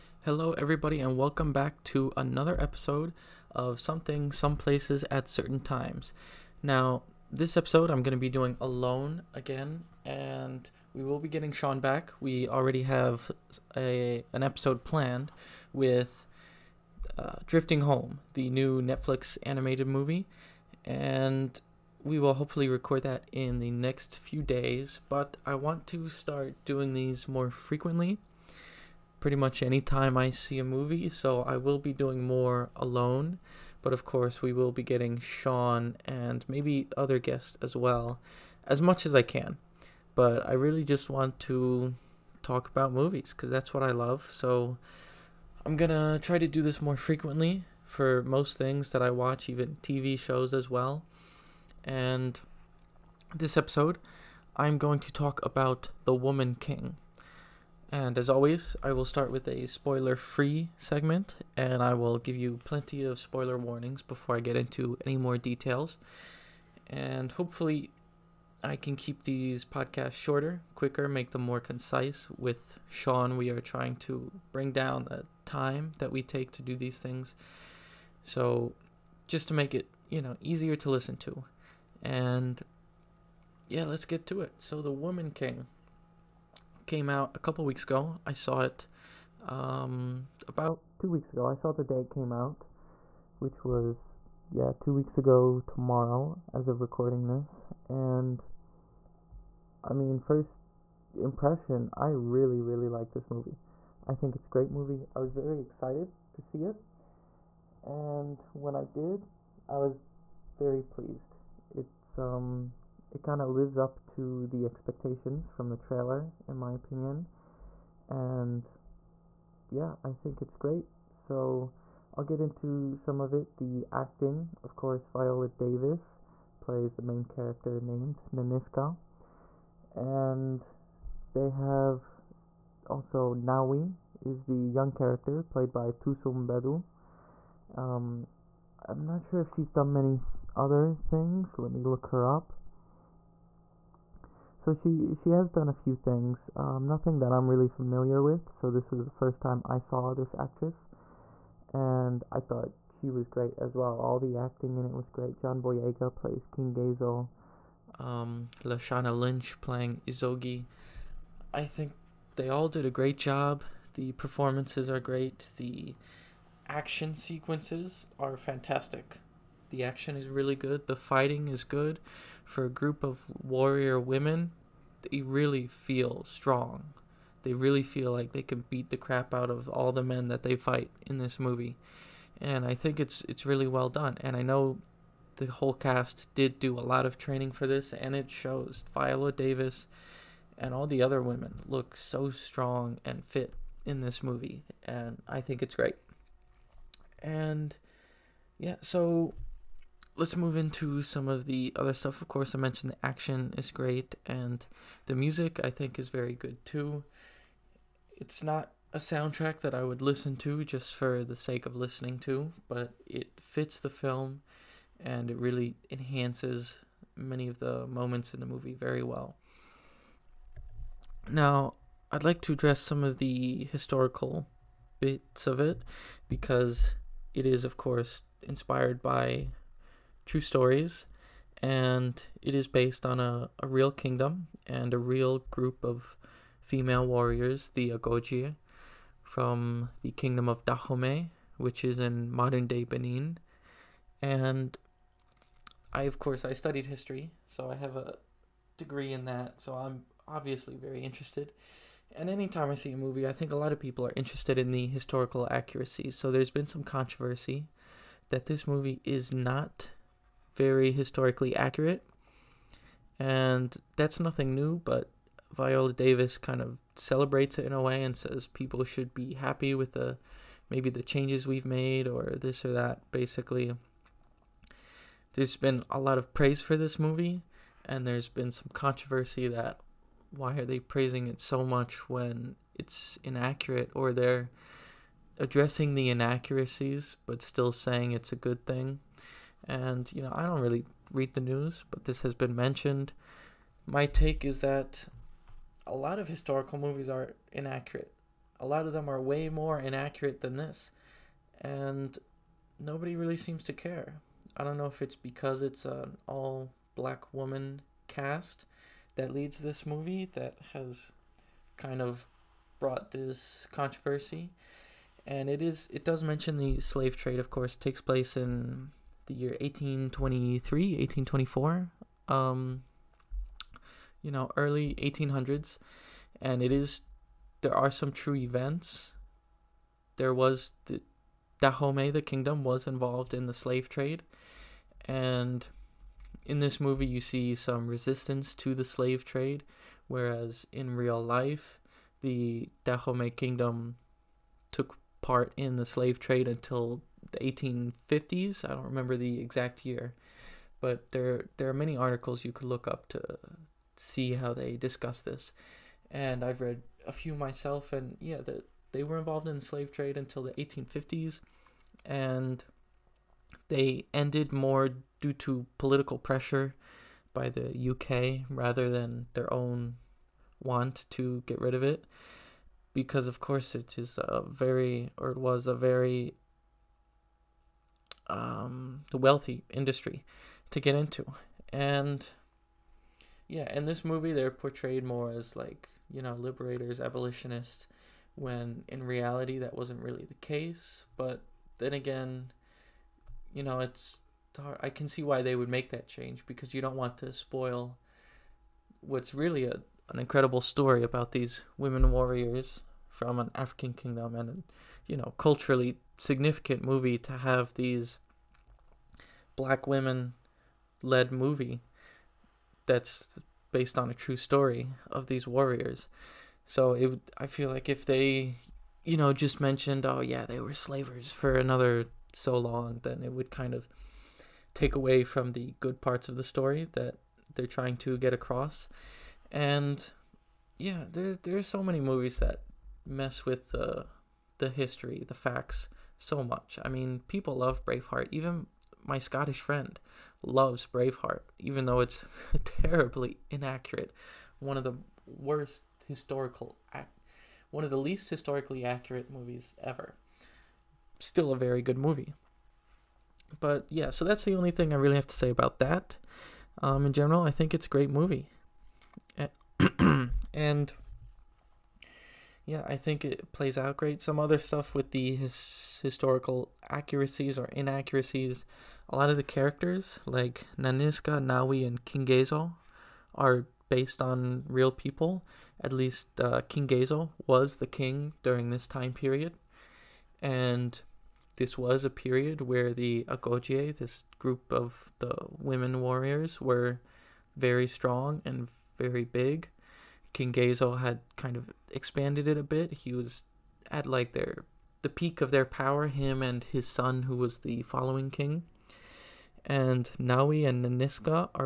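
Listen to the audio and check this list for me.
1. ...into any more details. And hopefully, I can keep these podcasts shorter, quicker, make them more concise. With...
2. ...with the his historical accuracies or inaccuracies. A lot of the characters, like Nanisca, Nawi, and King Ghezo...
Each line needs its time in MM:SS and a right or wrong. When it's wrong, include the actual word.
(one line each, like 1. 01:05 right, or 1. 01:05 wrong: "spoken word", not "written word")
1. 01:04 right
2. 07:44 right.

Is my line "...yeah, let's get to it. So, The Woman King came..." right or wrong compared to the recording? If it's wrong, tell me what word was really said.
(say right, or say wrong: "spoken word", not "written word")
right.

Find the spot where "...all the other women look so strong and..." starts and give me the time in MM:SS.
03:10.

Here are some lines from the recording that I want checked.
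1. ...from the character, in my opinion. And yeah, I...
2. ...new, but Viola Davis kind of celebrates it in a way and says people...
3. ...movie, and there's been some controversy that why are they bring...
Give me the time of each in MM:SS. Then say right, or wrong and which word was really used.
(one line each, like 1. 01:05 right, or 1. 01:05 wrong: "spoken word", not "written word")
1. 01:55 wrong: "trailer", not "character"
2. 04:24 right
3. 04:36 wrong: "praising", not "bring".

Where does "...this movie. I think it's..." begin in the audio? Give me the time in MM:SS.
01:43.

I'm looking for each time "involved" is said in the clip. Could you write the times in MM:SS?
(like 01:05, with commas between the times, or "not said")
05:32, 05:59.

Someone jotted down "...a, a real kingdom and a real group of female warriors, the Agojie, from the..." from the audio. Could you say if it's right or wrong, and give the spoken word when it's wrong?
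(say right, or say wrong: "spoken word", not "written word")
right.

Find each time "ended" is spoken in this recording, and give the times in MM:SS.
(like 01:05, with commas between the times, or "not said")
06:04.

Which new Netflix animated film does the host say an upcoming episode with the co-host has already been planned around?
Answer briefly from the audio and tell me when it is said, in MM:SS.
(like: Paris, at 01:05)
Drifting Home, at 00:17.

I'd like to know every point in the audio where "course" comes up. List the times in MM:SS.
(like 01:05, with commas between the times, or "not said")
00:34, 02:04, 03:22, 03:47, 04:06, 05:17, 06:13.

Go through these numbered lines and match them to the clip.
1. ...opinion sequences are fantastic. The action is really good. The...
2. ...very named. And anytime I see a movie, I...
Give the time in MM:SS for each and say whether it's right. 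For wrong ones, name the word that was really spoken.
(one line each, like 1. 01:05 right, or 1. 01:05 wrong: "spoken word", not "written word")
1. 02:46 wrong: "action", not "opinion"
2. 04:10 wrong: "interested", not "named".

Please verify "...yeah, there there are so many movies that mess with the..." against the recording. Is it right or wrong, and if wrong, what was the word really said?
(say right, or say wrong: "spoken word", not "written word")
right.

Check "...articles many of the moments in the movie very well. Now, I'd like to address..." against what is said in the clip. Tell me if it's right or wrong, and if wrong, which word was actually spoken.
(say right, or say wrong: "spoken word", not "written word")
wrong: "enhances", not "articles".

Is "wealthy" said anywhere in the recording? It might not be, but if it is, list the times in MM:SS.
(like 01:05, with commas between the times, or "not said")
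06:19.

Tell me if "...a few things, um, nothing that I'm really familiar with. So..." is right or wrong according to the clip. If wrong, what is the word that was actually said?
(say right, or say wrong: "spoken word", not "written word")
right.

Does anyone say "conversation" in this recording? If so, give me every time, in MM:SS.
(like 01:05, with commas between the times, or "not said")
not said.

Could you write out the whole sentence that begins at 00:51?
And this episode, I'm going to talk about The Woman King.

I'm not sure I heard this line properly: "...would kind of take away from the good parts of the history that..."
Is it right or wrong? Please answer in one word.
wrong.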